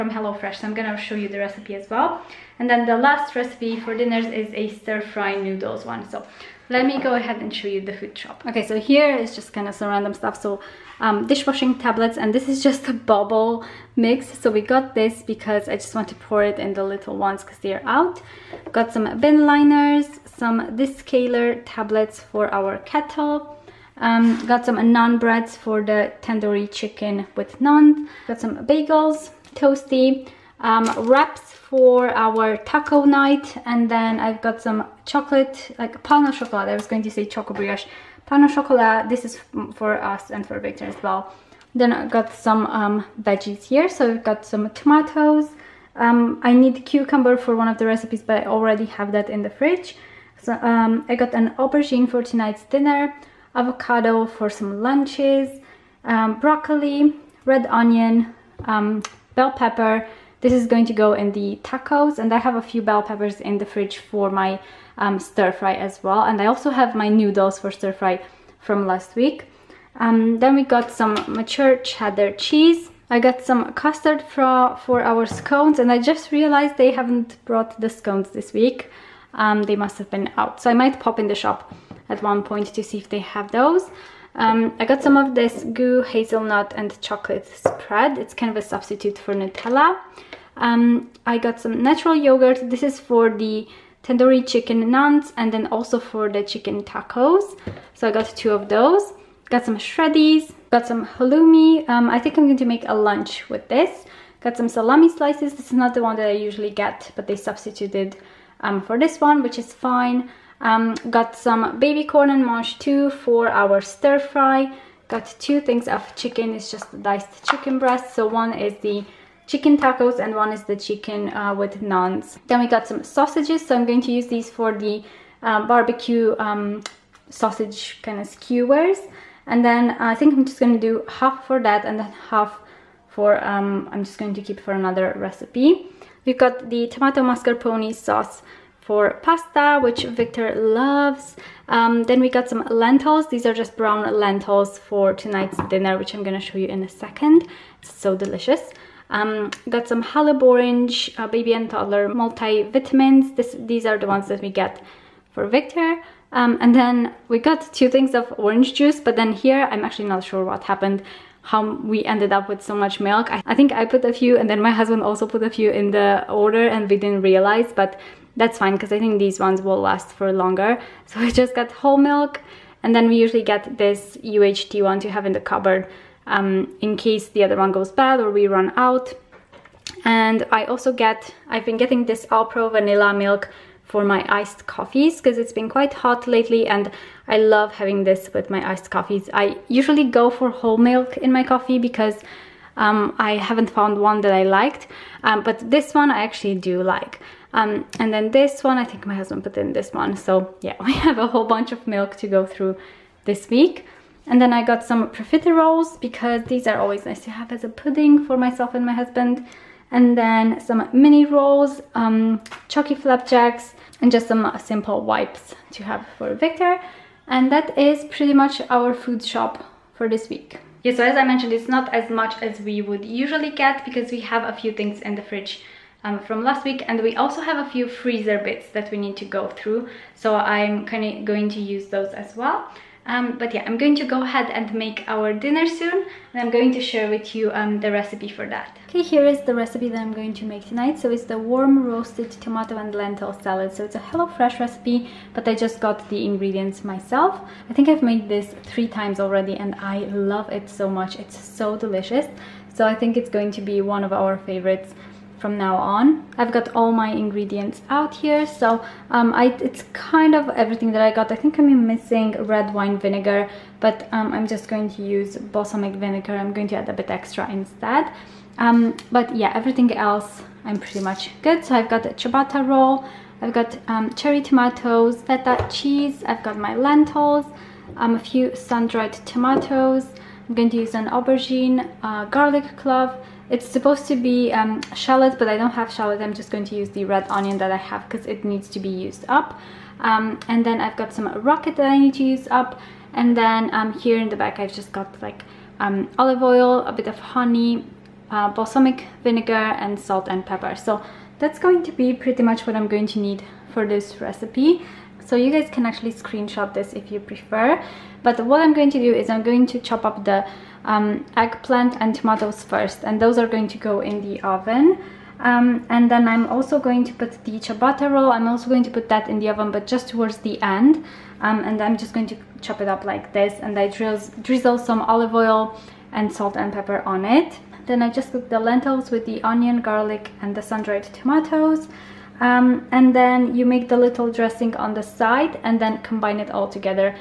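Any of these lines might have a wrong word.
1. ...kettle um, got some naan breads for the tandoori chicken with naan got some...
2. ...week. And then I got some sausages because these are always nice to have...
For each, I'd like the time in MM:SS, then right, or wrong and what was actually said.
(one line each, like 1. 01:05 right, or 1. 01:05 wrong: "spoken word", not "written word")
1. 00:22 right
2. 03:23 wrong: "profiteroles", not "sausages".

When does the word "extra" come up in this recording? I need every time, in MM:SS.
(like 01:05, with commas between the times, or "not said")
04:27.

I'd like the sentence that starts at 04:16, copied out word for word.
I've got all my ingredients out here, so um, I, it's kind of everything that I got.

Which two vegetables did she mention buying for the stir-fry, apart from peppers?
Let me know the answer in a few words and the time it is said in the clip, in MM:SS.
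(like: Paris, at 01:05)
Baby corn and mangetout, at 01:51.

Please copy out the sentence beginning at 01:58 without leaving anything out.
So one is the chicken tacos and one is the chicken uh, with naans.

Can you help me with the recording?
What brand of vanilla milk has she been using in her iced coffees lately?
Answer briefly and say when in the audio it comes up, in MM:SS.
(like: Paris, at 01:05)
Alpro, at 03:02.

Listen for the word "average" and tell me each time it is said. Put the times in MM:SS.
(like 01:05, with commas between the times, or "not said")
not said.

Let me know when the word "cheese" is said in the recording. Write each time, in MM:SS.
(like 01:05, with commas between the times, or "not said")
01:12, 04:35.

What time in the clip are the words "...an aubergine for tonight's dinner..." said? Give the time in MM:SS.
00:51.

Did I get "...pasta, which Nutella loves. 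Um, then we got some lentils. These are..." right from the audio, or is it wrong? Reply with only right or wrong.
wrong.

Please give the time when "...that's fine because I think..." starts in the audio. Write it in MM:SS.
02:48.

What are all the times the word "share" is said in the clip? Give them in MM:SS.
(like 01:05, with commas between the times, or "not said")
03:56.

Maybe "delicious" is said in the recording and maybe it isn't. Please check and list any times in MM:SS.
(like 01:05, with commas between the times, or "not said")
02:28, 04:11.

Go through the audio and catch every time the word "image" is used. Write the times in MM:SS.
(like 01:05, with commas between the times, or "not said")
not said.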